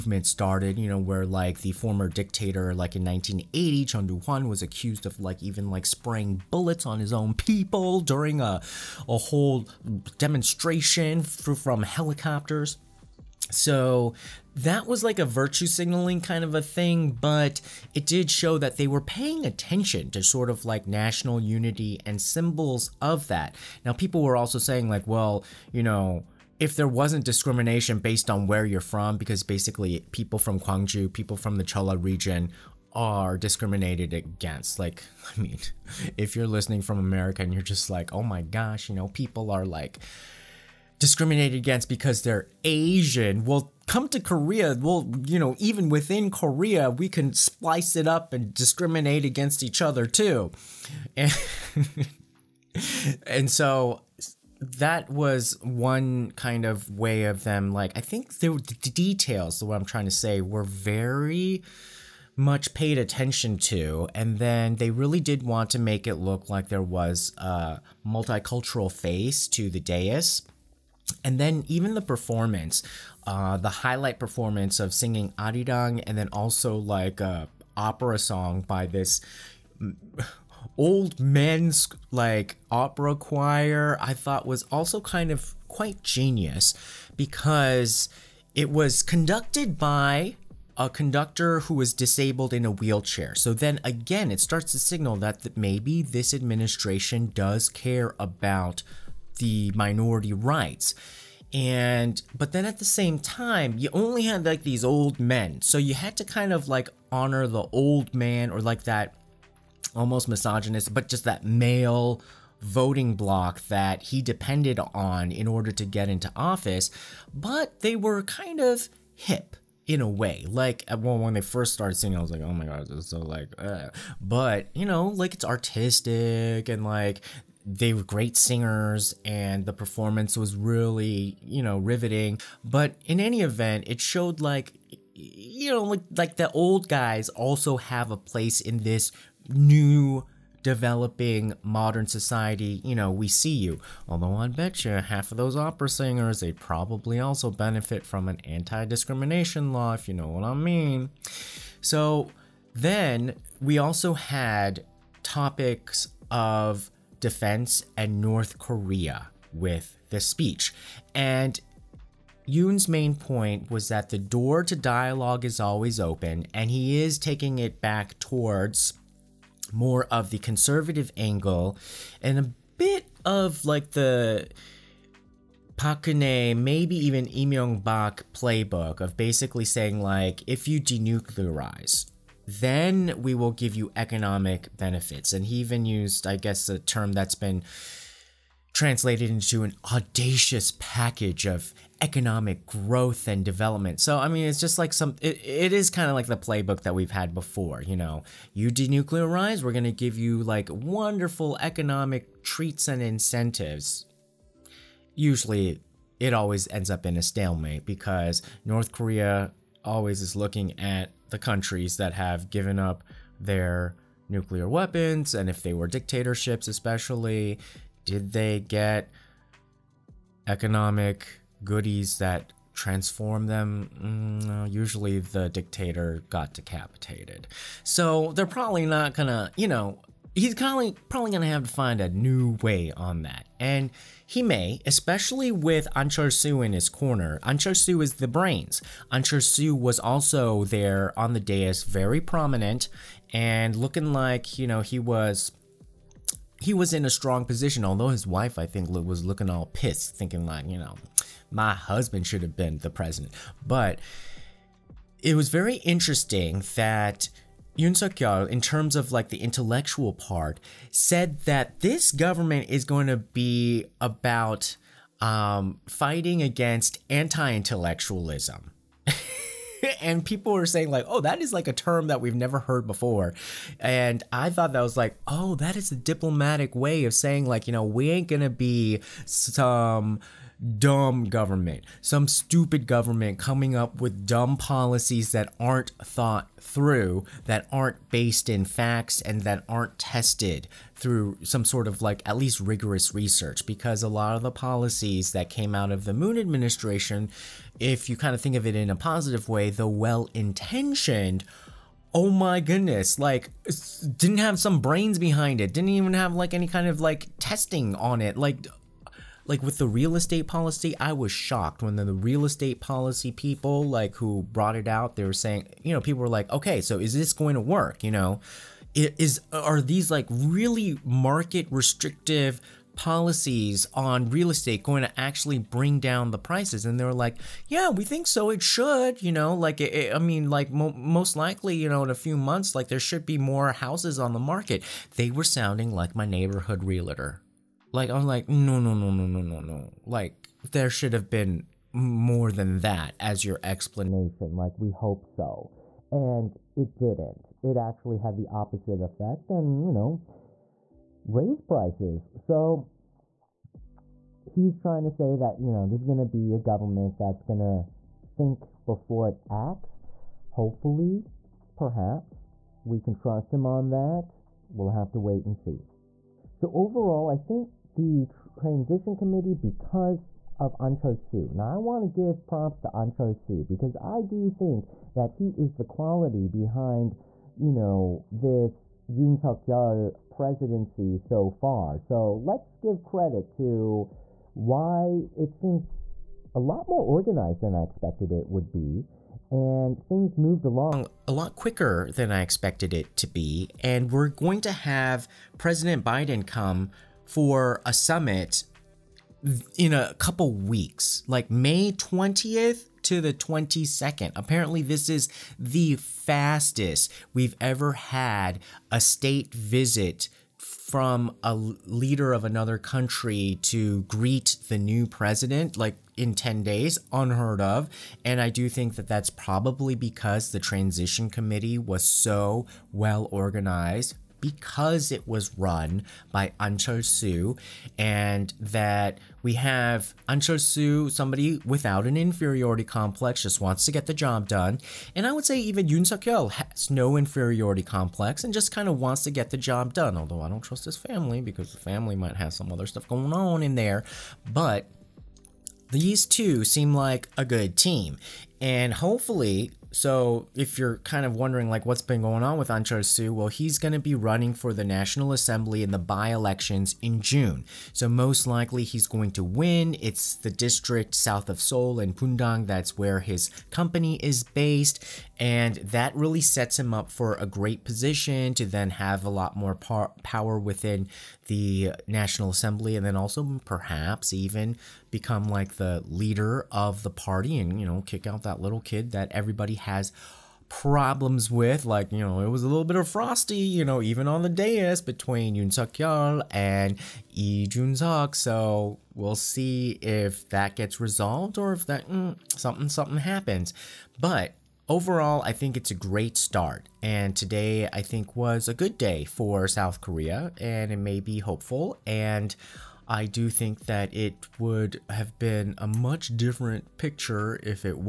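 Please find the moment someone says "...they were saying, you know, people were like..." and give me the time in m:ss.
5:15.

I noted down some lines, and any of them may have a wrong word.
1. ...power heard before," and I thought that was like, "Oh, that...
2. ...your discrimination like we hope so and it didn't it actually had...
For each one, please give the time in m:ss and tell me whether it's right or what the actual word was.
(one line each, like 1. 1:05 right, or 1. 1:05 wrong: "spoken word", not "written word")
1. 4:32 wrong: "never", not "power"
2. 5:43 wrong: "explanation", not "discrimination".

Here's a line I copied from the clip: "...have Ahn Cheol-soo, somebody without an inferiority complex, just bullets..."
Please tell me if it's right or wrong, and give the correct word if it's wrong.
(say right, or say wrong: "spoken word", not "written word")
wrong: "wants", not "bullets".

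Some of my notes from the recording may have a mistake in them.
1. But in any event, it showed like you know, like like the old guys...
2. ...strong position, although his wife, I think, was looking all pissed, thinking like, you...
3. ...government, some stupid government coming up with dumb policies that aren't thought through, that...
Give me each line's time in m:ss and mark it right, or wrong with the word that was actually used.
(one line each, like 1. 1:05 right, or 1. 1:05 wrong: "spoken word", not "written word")
1. 2:12 right
2. 4:07 right
3. 4:41 right.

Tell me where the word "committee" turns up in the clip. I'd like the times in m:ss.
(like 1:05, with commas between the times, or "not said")
6:09, 7:01.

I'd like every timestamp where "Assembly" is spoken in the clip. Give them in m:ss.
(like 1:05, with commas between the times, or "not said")
7:35, 7:52.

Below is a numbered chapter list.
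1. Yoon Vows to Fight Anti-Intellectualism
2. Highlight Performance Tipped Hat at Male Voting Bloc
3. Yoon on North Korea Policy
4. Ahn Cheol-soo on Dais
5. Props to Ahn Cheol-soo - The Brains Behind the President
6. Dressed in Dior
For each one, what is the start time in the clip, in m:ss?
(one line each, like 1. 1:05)
1. 4:19
2. 1:04
3. 2:34
4. 3:54
5. 6:04
6. 7:19.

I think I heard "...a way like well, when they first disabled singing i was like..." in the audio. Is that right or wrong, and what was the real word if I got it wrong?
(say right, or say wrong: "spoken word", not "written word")
wrong: "started", not "disabled".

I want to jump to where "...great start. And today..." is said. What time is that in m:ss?
8:15.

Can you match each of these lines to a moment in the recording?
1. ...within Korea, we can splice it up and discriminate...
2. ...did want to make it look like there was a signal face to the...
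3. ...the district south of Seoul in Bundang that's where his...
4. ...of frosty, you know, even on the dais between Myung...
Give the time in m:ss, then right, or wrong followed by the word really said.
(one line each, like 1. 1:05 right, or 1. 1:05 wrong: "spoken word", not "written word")
1. 0:45 right
2. 1:05 wrong: "multicultural", not "signal"
3. 7:40 right
4. 8:02 wrong: "Yoon", not "Myung".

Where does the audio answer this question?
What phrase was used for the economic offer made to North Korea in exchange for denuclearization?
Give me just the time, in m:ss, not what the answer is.
3:09.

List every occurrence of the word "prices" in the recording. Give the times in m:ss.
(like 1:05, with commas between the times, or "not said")
5:26, 5:51.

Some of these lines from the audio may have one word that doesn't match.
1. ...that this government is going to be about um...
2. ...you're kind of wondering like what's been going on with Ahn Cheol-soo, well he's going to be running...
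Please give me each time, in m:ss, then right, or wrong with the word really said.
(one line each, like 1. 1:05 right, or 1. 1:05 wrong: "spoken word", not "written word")
1. 4:21 right
2. 7:30 right.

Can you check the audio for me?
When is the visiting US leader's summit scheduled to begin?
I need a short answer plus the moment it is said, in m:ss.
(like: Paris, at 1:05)
May 20, at 6:41.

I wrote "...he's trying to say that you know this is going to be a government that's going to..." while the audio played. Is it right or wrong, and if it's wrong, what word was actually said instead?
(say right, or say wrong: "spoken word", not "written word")
right.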